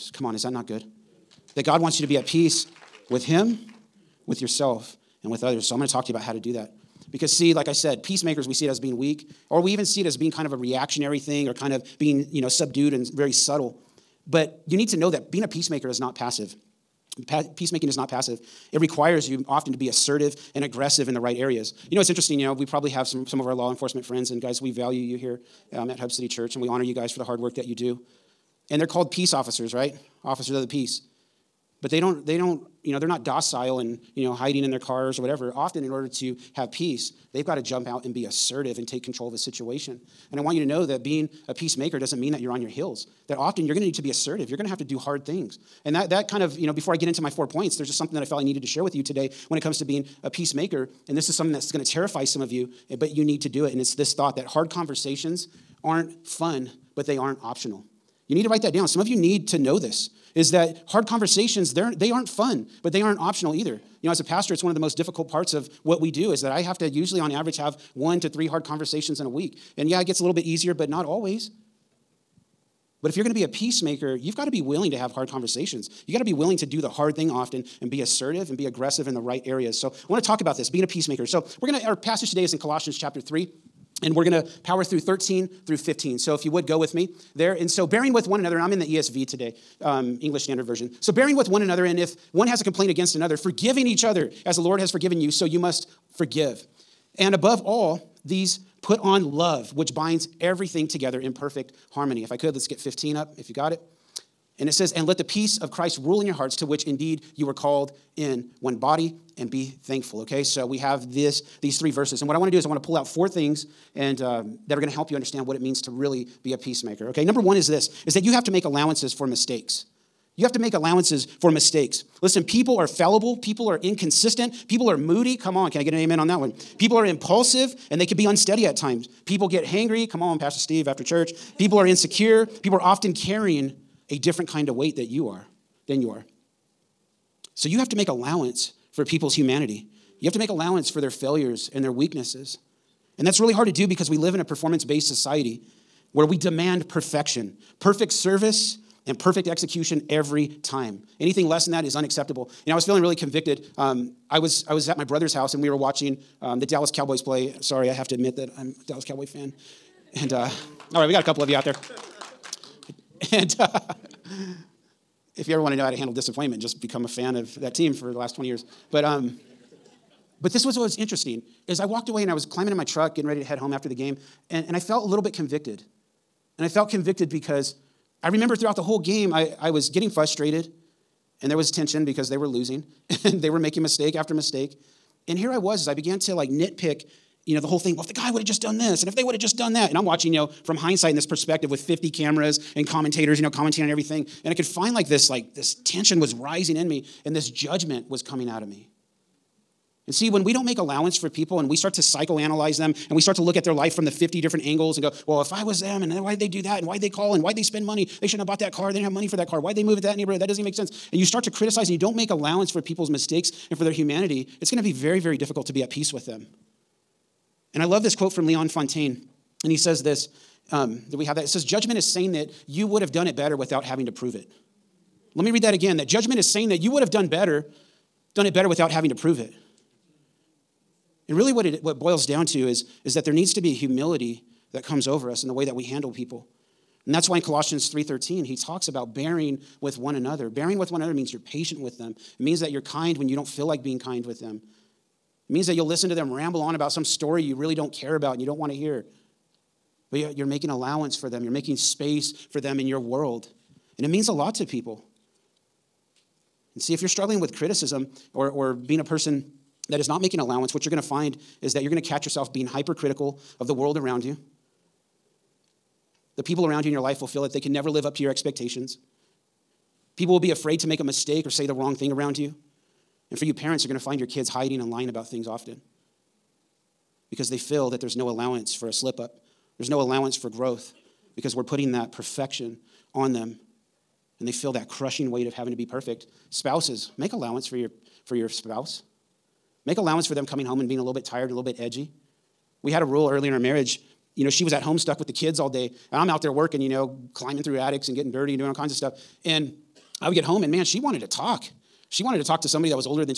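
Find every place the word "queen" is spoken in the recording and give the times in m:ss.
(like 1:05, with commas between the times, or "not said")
not said.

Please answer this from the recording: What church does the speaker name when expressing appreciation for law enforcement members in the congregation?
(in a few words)
Hub City Church.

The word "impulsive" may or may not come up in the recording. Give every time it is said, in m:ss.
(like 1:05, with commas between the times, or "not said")
2:07.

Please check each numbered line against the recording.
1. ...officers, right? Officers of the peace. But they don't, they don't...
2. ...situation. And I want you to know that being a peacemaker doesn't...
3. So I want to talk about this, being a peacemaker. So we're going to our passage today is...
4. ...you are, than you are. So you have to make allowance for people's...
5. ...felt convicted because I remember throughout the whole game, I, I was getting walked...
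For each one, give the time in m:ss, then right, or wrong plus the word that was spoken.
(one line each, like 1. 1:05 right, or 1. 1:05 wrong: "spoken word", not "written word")
1. 0:29 right
2. 0:39 right
3. 1:19 right
4. 2:15 right
5. 2:56 wrong: "frustrated", not "walked".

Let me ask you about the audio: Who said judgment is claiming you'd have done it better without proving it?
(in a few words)
Leon Fontaine.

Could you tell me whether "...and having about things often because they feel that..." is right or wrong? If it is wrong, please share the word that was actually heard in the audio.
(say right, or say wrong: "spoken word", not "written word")
wrong: "lying", not "having".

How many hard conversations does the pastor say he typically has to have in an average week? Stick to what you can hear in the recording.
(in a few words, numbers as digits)
1 to 3.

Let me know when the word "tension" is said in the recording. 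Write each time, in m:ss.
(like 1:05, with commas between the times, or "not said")
3:01, 3:15.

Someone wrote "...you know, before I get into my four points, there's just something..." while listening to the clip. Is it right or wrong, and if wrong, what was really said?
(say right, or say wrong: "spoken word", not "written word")
right.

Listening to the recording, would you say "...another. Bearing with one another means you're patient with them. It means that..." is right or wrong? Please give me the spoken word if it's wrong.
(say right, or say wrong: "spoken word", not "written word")
right.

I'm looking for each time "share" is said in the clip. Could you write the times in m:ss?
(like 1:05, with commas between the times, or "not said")
0:48.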